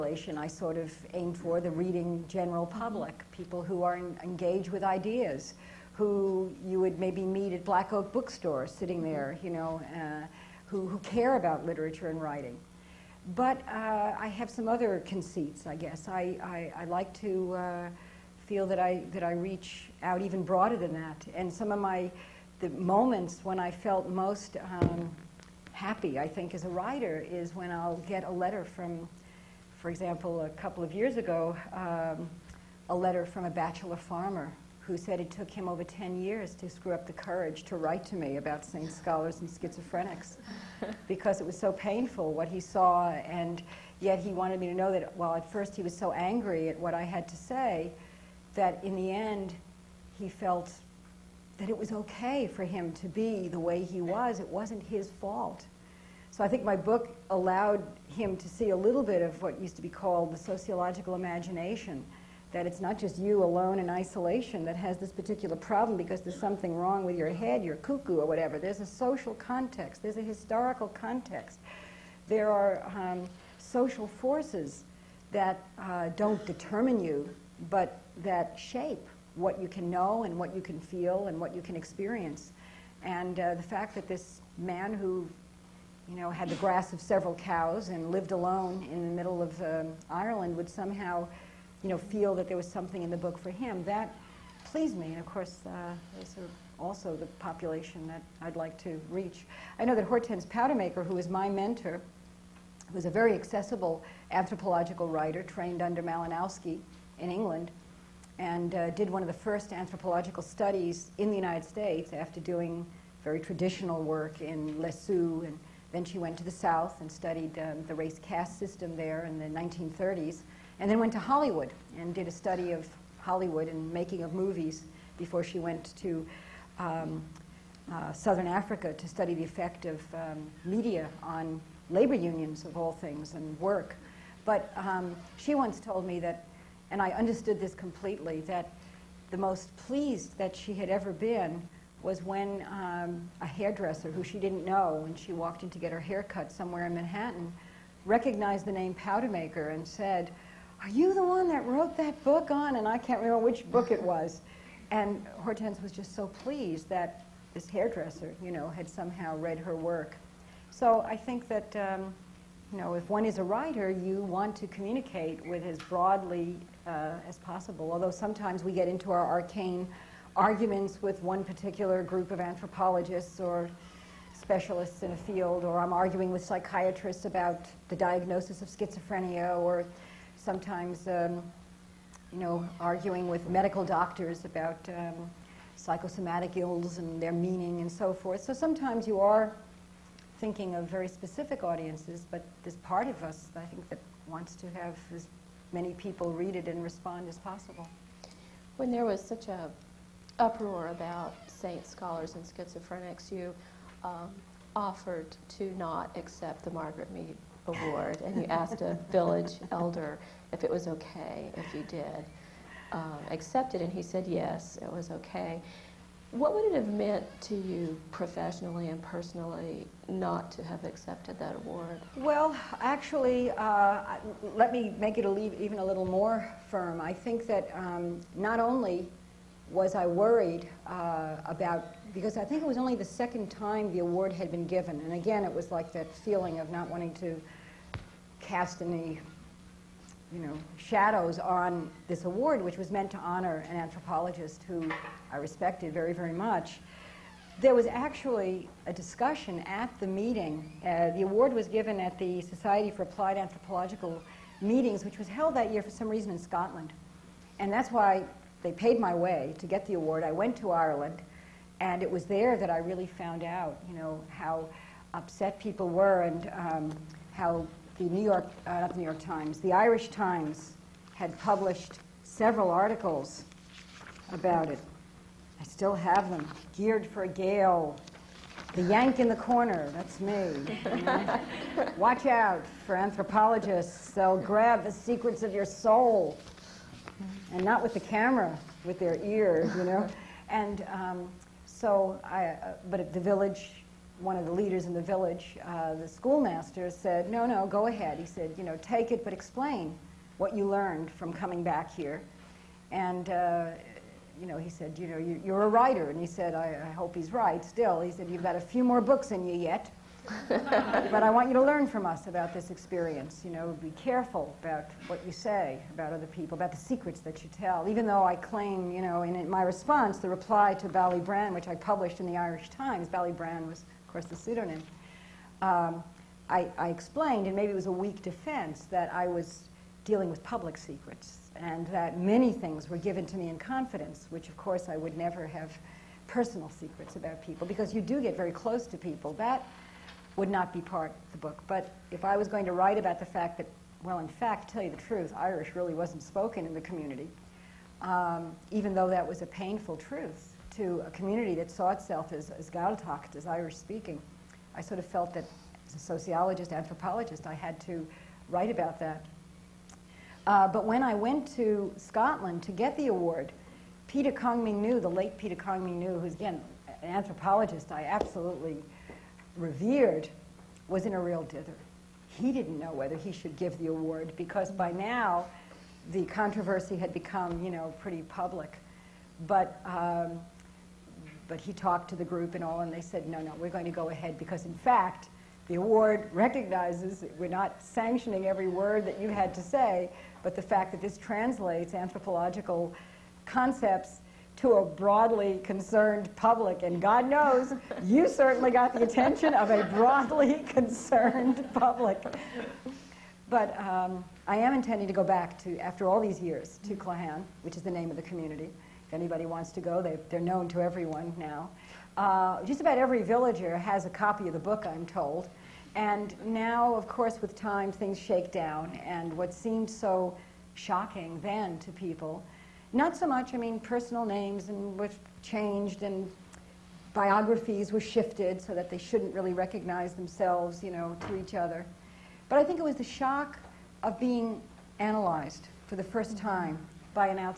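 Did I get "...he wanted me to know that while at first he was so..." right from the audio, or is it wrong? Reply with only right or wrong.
right.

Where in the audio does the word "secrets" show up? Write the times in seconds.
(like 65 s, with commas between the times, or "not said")
284 s, 316 s, 330 s, 336 s.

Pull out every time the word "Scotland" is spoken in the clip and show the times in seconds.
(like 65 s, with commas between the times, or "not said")
256 s, 361 s.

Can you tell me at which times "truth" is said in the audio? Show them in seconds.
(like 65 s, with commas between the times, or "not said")
344 s, 349 s.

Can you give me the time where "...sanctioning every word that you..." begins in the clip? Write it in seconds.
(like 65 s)
387 s.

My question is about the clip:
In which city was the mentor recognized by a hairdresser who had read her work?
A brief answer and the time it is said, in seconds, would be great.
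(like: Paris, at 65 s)
Manhattan, at 146 s.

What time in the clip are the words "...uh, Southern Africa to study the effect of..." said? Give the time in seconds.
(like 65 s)
127 s.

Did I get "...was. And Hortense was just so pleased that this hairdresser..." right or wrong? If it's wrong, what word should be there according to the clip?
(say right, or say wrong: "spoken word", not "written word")
right.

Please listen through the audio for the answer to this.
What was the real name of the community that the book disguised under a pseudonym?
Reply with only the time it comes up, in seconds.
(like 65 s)
406 s.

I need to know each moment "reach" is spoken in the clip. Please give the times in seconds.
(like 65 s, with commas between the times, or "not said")
19 s, 99 s.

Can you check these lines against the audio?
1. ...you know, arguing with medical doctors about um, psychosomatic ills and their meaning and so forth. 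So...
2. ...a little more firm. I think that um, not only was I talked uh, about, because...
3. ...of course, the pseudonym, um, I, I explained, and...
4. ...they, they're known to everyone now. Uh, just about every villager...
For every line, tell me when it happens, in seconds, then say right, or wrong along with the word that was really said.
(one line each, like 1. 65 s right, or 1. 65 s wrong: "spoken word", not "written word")
1. 182 s right
2. 225 s wrong: "worried", not "talked"
3. 324 s right
4. 410 s right.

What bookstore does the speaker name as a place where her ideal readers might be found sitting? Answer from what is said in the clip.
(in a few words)
Black Oak Bookstore.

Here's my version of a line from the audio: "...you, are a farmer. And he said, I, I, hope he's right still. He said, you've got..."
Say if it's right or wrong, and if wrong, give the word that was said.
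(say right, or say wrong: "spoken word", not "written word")
wrong: "writer", not "farmer".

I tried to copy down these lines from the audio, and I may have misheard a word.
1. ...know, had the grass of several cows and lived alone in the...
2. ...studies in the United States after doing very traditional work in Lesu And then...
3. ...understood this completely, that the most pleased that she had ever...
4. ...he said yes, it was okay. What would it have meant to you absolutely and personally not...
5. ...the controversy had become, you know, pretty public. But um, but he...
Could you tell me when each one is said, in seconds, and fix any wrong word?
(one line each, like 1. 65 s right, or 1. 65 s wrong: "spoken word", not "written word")
1. 86 s right
2. 110 s right
3. 137 s right
4. 213 s wrong: "professionally", not "absolutely"
5. 376 s right.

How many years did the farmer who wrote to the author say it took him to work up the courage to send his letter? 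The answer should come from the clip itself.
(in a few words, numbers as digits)
10.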